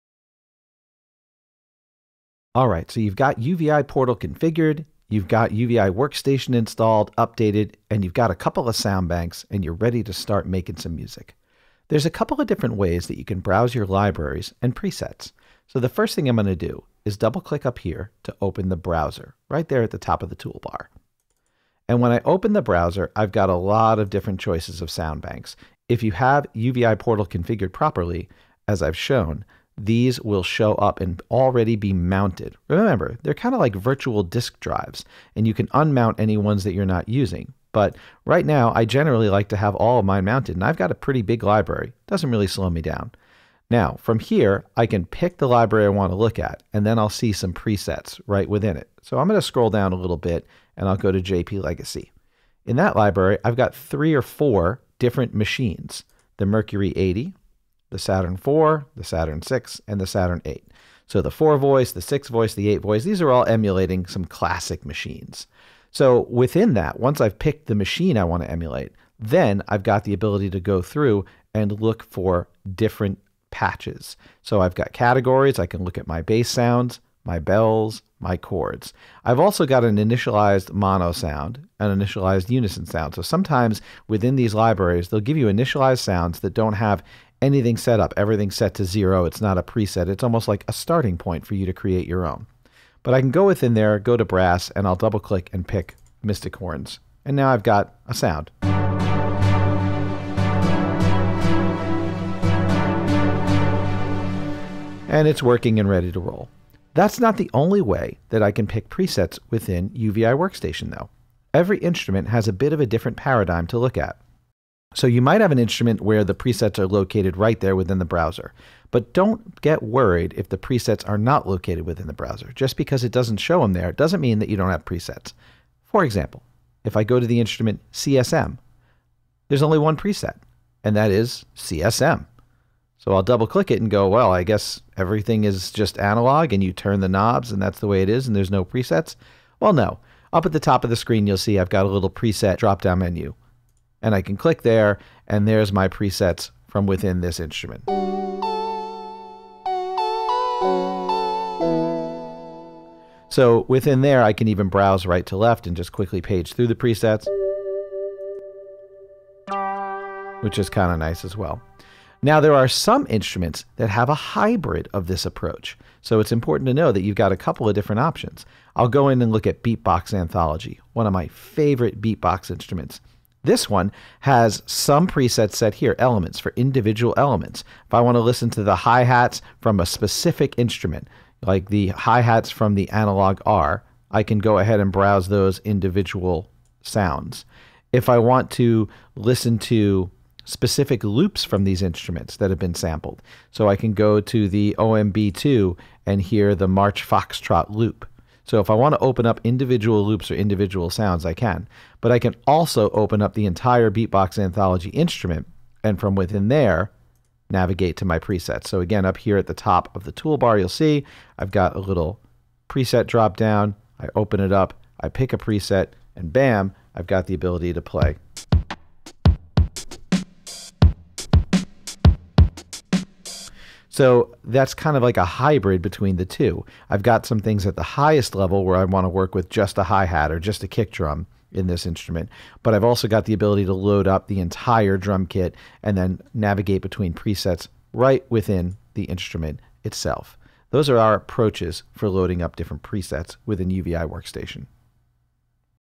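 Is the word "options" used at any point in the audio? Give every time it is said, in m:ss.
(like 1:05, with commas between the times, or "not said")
2:47.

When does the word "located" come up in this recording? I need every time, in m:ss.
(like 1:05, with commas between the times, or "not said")
1:56, 2:01.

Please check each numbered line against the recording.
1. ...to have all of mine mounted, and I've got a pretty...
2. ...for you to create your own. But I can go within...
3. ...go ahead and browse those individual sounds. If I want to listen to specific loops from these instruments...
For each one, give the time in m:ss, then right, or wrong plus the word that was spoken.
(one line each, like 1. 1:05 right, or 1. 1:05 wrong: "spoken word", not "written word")
1. 0:39 right
2. 1:31 right
3. 3:04 right.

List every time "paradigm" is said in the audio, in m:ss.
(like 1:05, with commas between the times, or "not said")
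1:53.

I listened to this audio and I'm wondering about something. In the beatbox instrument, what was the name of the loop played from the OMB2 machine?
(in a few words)
March Foxtrot.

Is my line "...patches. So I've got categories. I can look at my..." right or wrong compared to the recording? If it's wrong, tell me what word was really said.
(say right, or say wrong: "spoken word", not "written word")
right.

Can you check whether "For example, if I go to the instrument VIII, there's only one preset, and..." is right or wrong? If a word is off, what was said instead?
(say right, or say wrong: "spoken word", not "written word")
wrong: "CSM", not "VIII".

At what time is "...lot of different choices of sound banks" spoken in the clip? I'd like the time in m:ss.
0:23.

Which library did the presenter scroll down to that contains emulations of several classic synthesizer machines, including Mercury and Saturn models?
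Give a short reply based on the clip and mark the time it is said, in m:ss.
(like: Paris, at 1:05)
JP Legacy, at 0:51.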